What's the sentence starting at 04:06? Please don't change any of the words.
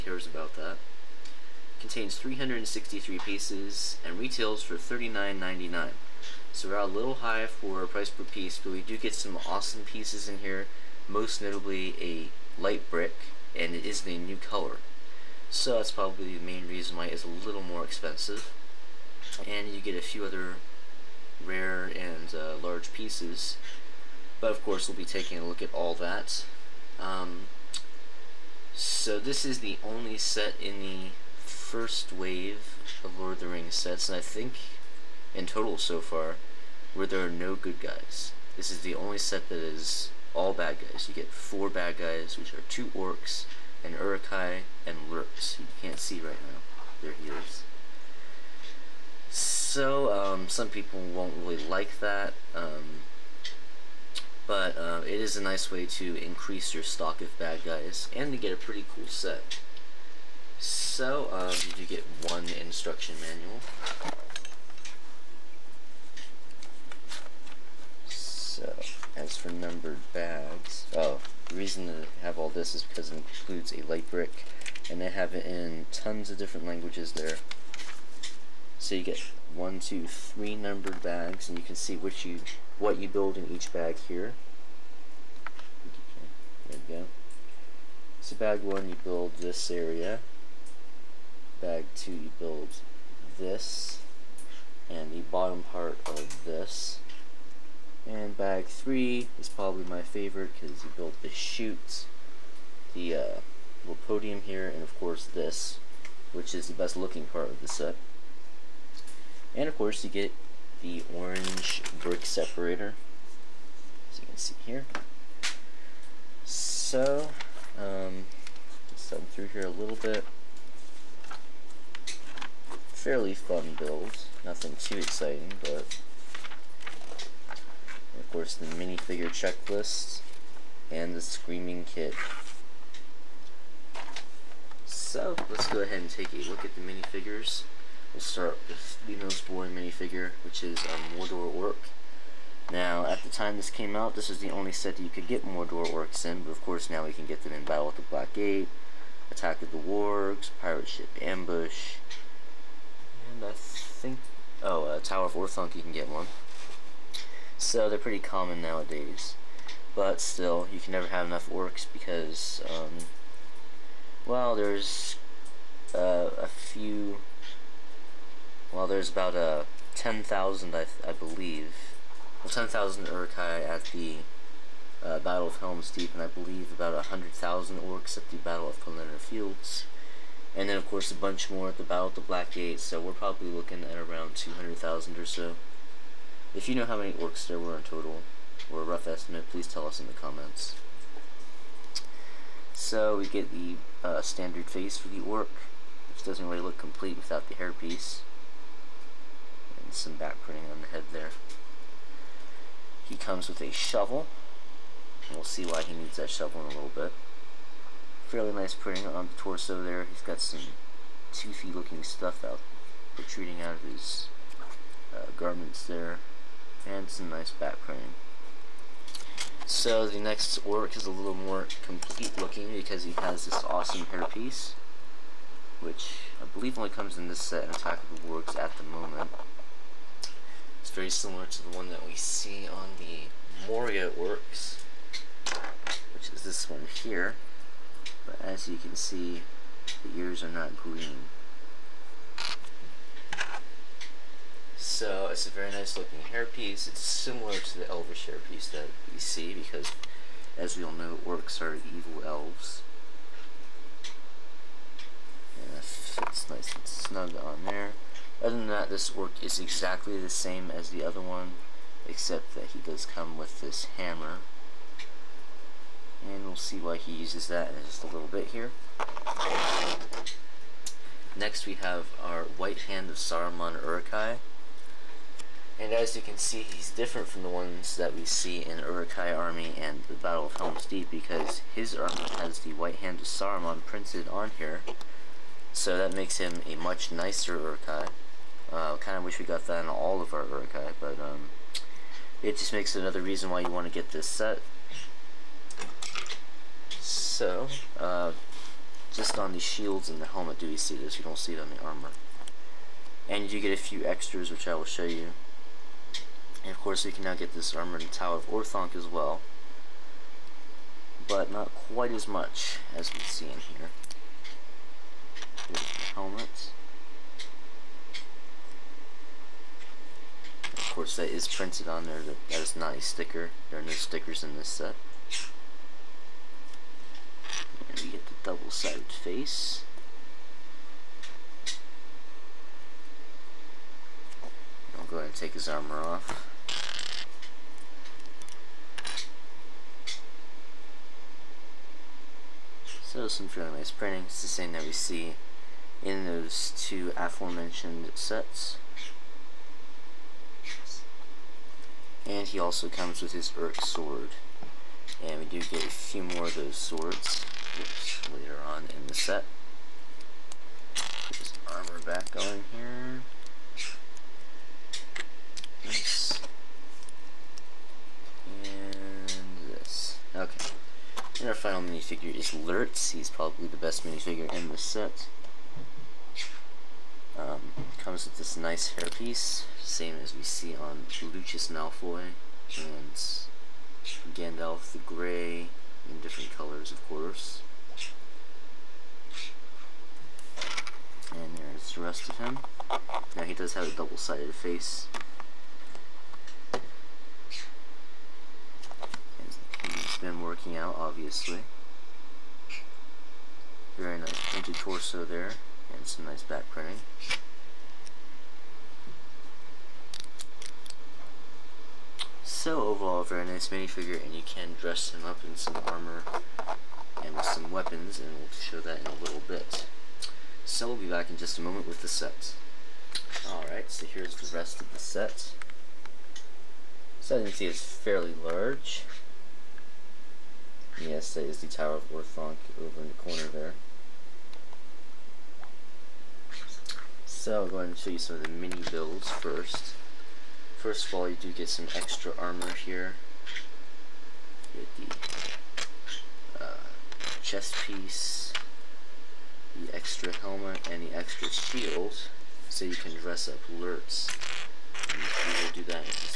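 It's similar to the elvish hairpiece that we see because, as we all know, orcs are evil elves.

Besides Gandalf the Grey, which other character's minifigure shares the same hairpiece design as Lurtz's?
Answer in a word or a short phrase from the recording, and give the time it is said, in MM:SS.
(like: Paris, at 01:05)
Lucius Malfoy, at 06:21.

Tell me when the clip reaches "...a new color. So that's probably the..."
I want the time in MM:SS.
00:14.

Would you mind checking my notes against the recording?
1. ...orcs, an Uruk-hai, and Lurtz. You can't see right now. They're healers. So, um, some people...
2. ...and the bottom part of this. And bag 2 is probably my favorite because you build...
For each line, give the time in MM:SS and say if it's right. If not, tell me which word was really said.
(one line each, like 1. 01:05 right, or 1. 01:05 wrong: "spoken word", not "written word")
1. 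00:42 right
2. 01:34 wrong: "3", not "2".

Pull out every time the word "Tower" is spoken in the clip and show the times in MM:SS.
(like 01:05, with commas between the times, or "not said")
02:34, 05:08, 07:11.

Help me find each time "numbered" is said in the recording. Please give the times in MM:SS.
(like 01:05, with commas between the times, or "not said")
01:09, 01:20.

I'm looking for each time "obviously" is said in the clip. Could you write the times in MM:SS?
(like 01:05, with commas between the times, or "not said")
06:40.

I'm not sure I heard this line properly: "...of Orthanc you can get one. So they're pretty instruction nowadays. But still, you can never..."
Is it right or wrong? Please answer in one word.
wrong.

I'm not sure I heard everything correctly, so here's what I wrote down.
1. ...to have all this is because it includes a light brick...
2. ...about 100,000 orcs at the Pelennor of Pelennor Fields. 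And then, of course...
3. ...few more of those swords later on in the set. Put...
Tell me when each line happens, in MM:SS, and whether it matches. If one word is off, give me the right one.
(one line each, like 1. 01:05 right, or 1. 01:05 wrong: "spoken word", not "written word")
1. 01:11 right
2. 02:56 wrong: "Battle", not "Pelennor"
3. 05:55 right.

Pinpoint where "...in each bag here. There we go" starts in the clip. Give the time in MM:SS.
01:23.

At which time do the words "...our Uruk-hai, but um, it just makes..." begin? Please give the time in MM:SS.
04:50.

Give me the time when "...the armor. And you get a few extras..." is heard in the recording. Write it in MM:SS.
05:01.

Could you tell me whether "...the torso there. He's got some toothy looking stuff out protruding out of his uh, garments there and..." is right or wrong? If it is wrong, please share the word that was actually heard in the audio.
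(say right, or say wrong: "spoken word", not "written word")
right.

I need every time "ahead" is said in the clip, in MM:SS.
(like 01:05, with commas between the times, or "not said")
02:15, 05:35, 07:17.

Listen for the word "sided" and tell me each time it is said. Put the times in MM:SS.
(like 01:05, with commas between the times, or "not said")
05:28, 06:33.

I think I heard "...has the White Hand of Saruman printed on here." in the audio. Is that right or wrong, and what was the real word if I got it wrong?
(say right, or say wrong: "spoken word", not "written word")
right.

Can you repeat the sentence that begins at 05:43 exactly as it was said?
So some nice printing It's the same that we see in those two aforementioned sets.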